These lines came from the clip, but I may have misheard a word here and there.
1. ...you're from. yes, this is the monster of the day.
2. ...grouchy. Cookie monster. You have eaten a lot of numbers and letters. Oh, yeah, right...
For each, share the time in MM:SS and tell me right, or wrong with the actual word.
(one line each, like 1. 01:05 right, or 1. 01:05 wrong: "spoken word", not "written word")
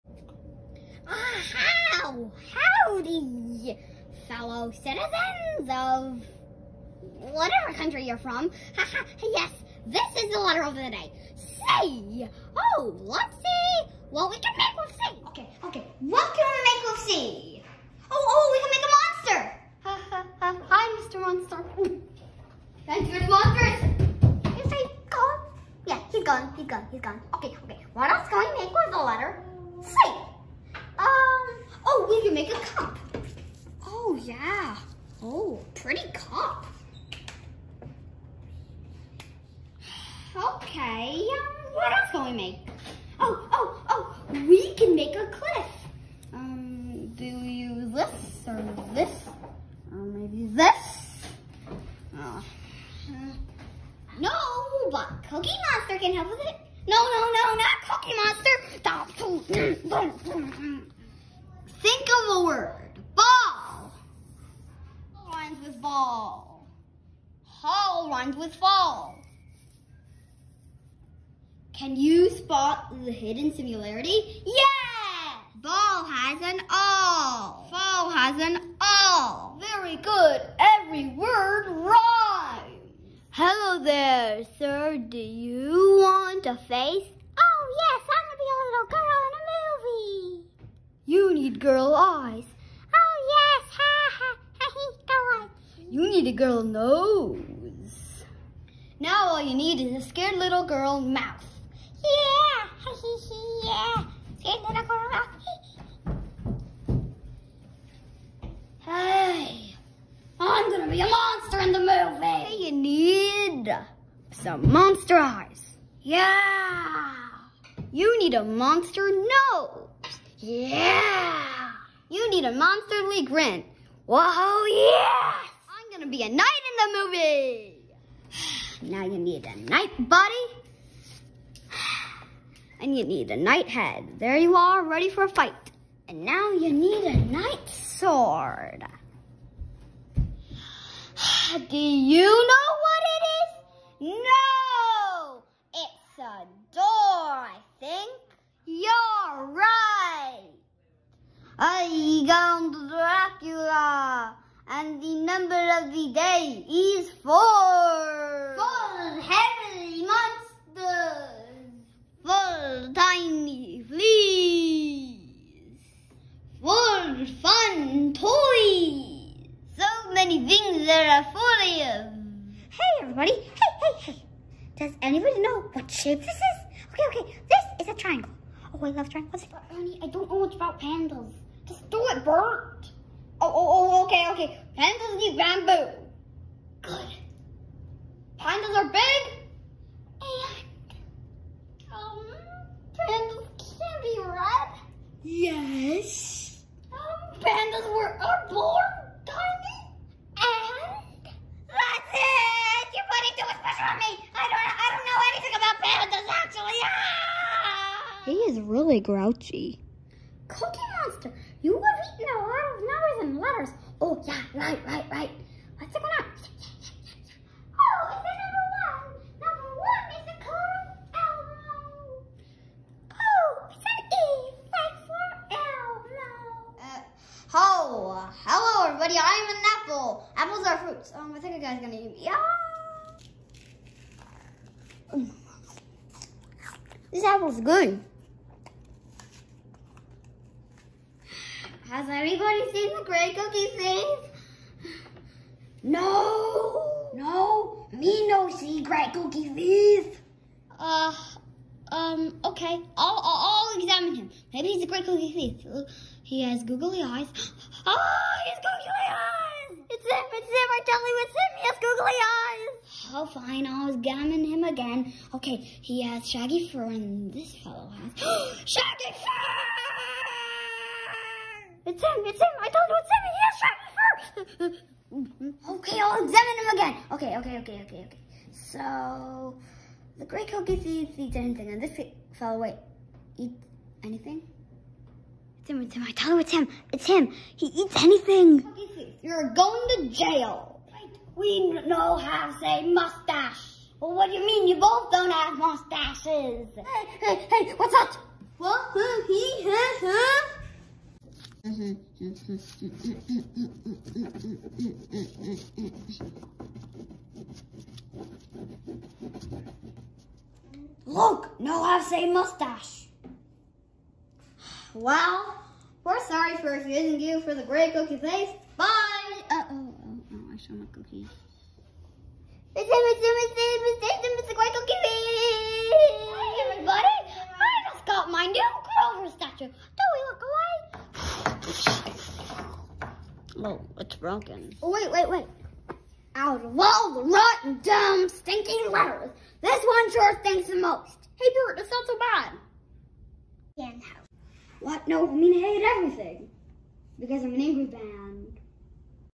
1. 00:08 wrong: "letter", not "monster"
2. 03:28 right.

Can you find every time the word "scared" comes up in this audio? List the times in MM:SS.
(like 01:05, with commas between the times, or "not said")
01:40, 01:44.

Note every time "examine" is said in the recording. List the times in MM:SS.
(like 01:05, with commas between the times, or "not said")
04:13, 04:23, 04:36.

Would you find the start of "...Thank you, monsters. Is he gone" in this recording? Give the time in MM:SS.
00:22.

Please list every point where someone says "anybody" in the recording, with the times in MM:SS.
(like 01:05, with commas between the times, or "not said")
02:55, 04:02.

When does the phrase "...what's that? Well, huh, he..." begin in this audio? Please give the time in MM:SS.
04:57.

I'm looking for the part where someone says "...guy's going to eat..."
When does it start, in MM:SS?
03:51.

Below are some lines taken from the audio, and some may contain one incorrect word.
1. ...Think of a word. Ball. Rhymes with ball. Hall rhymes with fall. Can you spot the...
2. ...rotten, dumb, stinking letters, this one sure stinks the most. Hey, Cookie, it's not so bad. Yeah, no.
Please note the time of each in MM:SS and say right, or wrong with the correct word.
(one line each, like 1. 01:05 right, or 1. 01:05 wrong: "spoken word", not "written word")
1. 01:01 right
2. 05:37 wrong: "Bert", not "Cookie".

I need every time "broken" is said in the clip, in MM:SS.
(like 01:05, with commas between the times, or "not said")
05:34.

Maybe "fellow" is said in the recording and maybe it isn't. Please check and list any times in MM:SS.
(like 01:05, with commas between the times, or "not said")
00:04, 04:27, 04:42.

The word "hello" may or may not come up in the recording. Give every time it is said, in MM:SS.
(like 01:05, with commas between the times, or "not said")
01:23, 03:48.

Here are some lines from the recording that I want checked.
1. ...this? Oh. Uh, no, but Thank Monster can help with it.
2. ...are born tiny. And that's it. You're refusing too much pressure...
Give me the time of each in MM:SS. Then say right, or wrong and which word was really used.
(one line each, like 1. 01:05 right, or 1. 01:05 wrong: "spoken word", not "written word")
1. 00:50 wrong: "Cookie", not "Thank"
2. 03:18 wrong: "putting", not "refusing".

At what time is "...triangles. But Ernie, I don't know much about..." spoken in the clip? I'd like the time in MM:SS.
02:59.